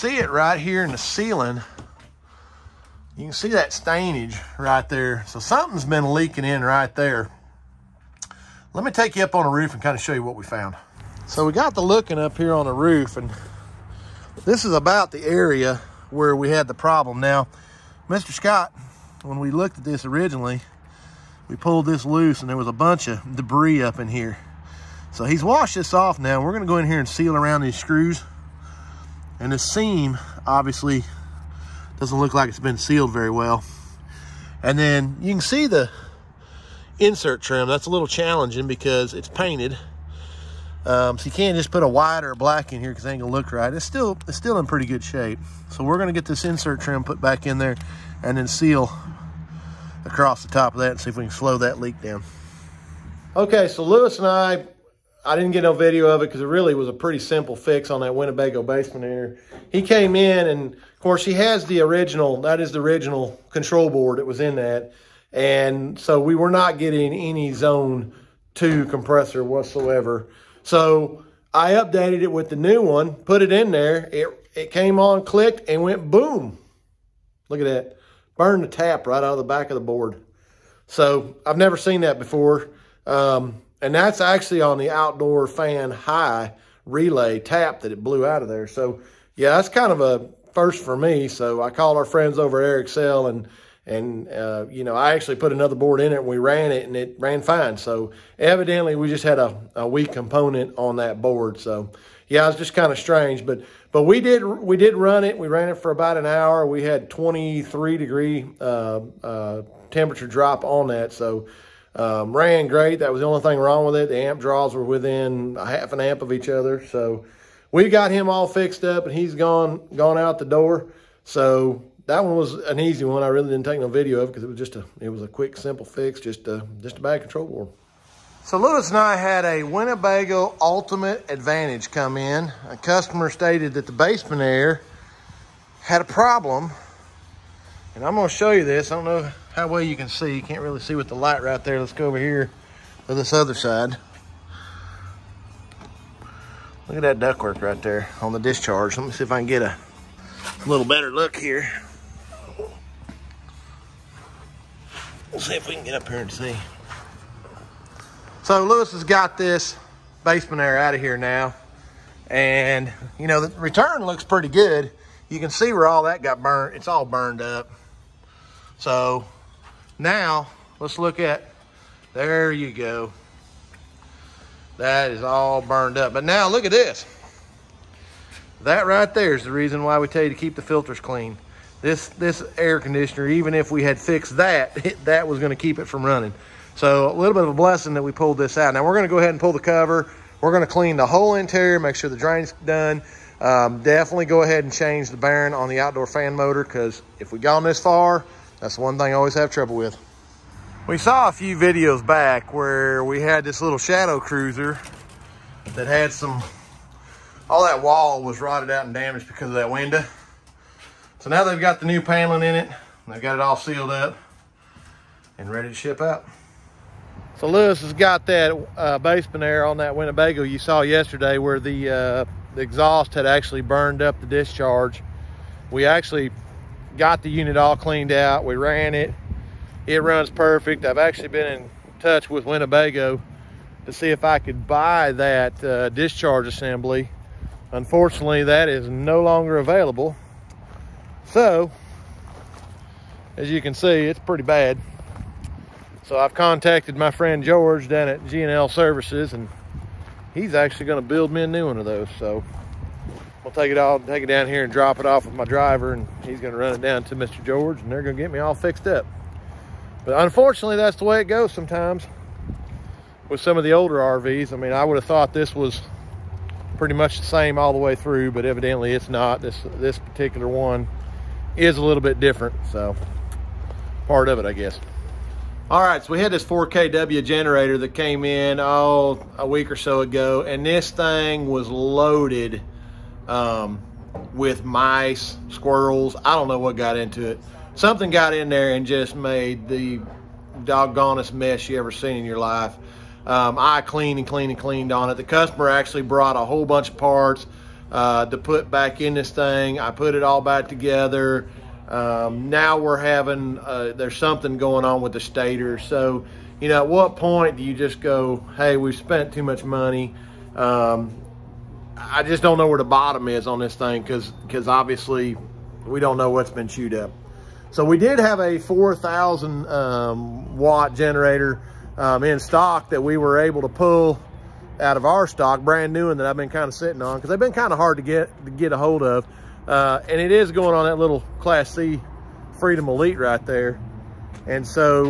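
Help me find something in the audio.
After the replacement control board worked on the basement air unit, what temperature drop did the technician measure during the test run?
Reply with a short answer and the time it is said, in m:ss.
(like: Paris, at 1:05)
23 degrees, at 1:47.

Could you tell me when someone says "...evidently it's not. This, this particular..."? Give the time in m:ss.
4:28.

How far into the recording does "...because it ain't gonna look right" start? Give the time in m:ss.
0:42.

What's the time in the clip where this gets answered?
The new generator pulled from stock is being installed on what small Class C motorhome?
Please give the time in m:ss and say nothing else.
5:32.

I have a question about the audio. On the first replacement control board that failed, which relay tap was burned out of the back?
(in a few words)
outdoor fan high relay.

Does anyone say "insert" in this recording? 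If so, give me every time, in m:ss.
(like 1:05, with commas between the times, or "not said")
0:36, 0:46.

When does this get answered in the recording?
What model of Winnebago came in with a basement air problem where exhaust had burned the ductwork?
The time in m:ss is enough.
2:10.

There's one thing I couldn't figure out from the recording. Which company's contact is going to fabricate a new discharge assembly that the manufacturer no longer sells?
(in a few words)
GNL Services.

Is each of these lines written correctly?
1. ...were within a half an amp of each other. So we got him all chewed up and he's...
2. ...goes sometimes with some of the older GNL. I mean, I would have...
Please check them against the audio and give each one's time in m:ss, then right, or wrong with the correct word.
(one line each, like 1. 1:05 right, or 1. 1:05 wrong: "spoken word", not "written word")
1. 1:54 wrong: "fixed", not "chewed"
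2. 4:21 wrong: "RVs", not "GNL".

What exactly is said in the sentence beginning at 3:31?
So now they've got the new paneling in it.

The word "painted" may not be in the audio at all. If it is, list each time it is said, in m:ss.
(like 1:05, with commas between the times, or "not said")
0:39.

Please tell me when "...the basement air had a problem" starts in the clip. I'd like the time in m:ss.
2:13.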